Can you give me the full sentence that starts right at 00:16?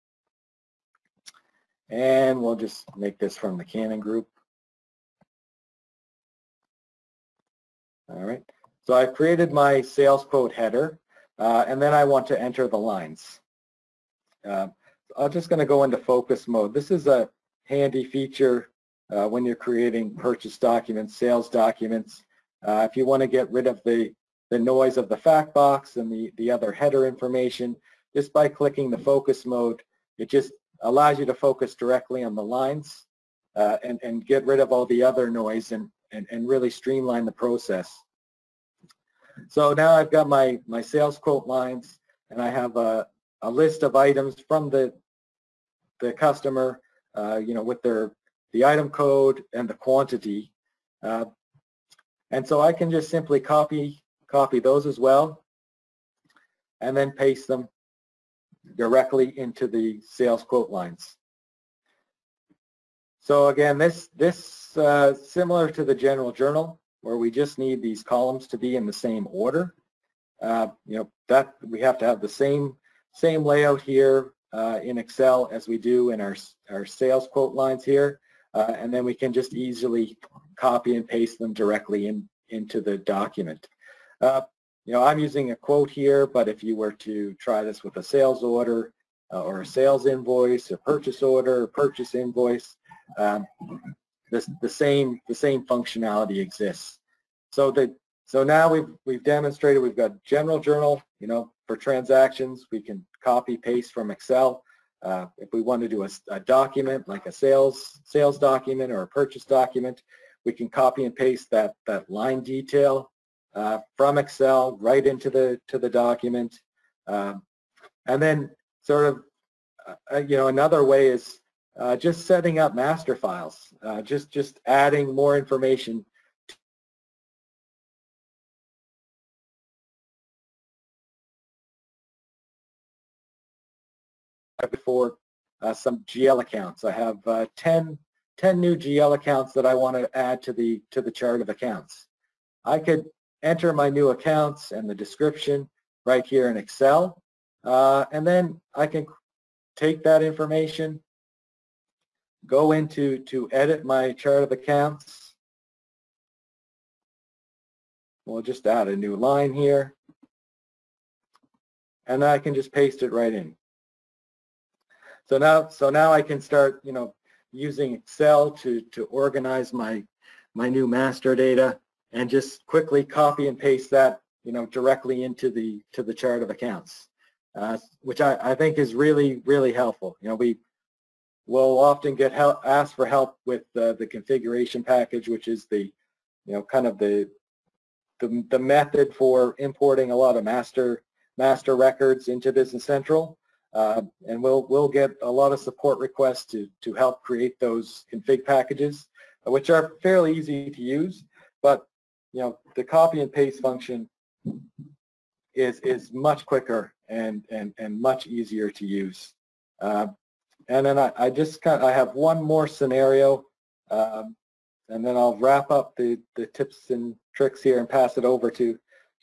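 This is a handy feature uh, when you're creating purchase documents, sales documents.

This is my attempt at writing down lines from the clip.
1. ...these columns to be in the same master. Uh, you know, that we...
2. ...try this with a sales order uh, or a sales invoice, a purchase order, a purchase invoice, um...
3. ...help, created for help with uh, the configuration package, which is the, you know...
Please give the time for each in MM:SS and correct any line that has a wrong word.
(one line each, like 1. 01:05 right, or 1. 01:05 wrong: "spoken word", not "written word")
1. 01:07 wrong: "order", not "master"
2. 01:27 right
3. 03:02 wrong: "asked", not "created".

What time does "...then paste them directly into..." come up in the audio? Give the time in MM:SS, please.
00:56.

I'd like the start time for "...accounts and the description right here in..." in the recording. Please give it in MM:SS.
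02:24.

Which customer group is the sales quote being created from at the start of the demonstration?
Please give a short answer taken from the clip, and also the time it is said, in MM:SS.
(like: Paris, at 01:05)
Canon, at 00:03.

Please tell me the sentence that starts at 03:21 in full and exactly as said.
But you know the copy and paste function is is much quicker and and and much easier to use.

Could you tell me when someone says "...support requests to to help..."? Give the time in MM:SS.
03:15.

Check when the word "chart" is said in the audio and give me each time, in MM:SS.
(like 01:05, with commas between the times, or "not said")
02:21, 02:34, 02:56.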